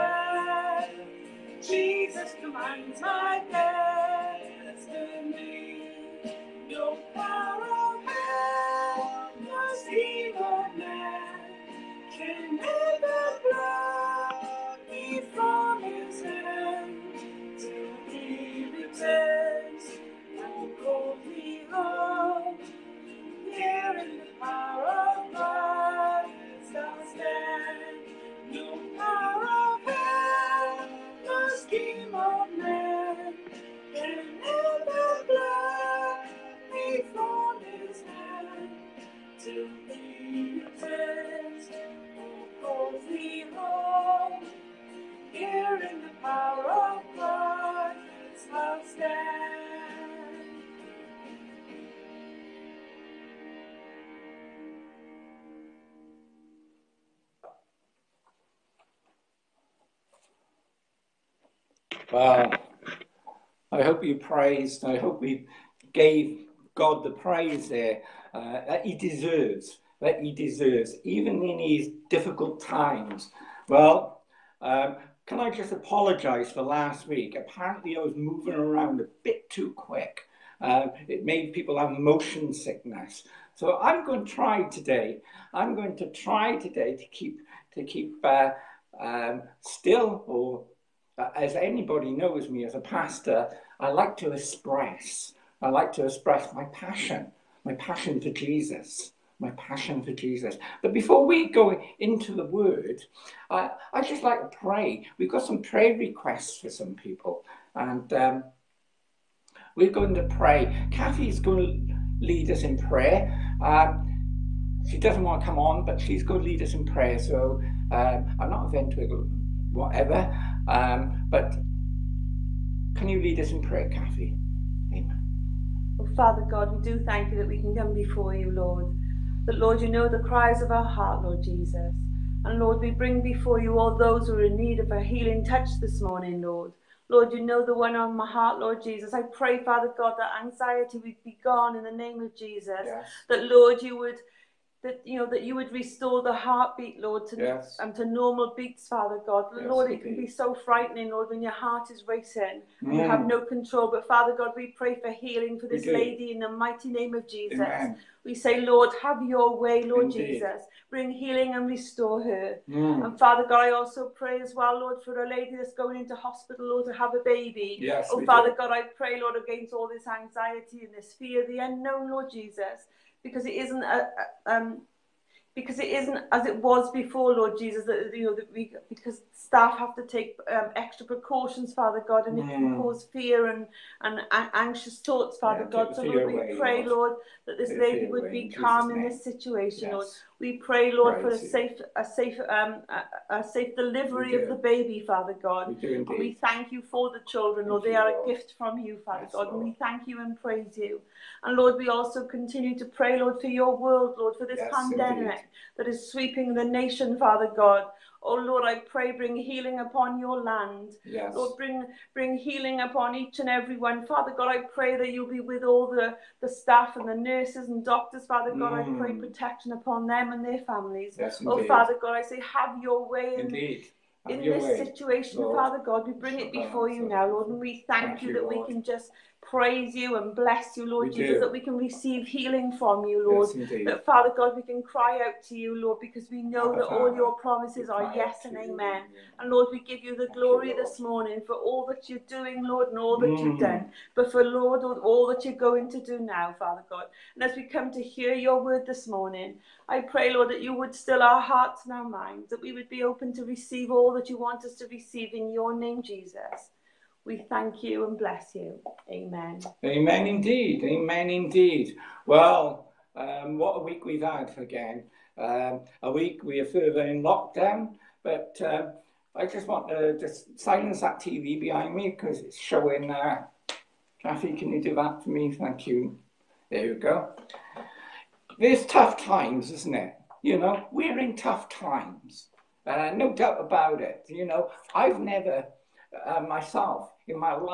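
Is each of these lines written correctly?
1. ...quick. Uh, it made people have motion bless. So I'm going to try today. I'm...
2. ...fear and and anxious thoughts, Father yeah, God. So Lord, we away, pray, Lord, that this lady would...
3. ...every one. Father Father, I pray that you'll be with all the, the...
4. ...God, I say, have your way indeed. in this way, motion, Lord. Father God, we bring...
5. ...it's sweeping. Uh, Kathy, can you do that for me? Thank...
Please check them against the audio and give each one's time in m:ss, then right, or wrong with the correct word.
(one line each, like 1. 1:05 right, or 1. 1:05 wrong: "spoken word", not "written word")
1. 1:19 wrong: "sickness", not "bless"
2. 3:03 right
3. 3:33 wrong: "God", not "Father"
4. 3:41 wrong: "situation", not "motion"
5. 4:32 wrong: "showing", not "sweeping".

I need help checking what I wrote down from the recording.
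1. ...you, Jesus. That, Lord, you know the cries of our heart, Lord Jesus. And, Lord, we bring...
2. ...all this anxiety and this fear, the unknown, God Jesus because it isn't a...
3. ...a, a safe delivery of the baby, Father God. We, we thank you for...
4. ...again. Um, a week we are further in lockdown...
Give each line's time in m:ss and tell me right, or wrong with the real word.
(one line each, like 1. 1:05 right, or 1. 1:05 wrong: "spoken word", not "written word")
1. 2:08 wrong: "Lord", not "Jesus"
2. 2:49 wrong: "Lord", not "God"
3. 3:12 right
4. 4:24 right.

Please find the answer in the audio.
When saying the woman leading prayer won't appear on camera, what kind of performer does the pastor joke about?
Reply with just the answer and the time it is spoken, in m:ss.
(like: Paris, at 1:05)
ventriloquist, at 1:58.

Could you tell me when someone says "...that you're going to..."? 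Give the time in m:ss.
4:05.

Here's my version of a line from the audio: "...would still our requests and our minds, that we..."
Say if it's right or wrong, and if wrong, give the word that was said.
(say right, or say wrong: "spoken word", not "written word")
wrong: "hearts", not "requests".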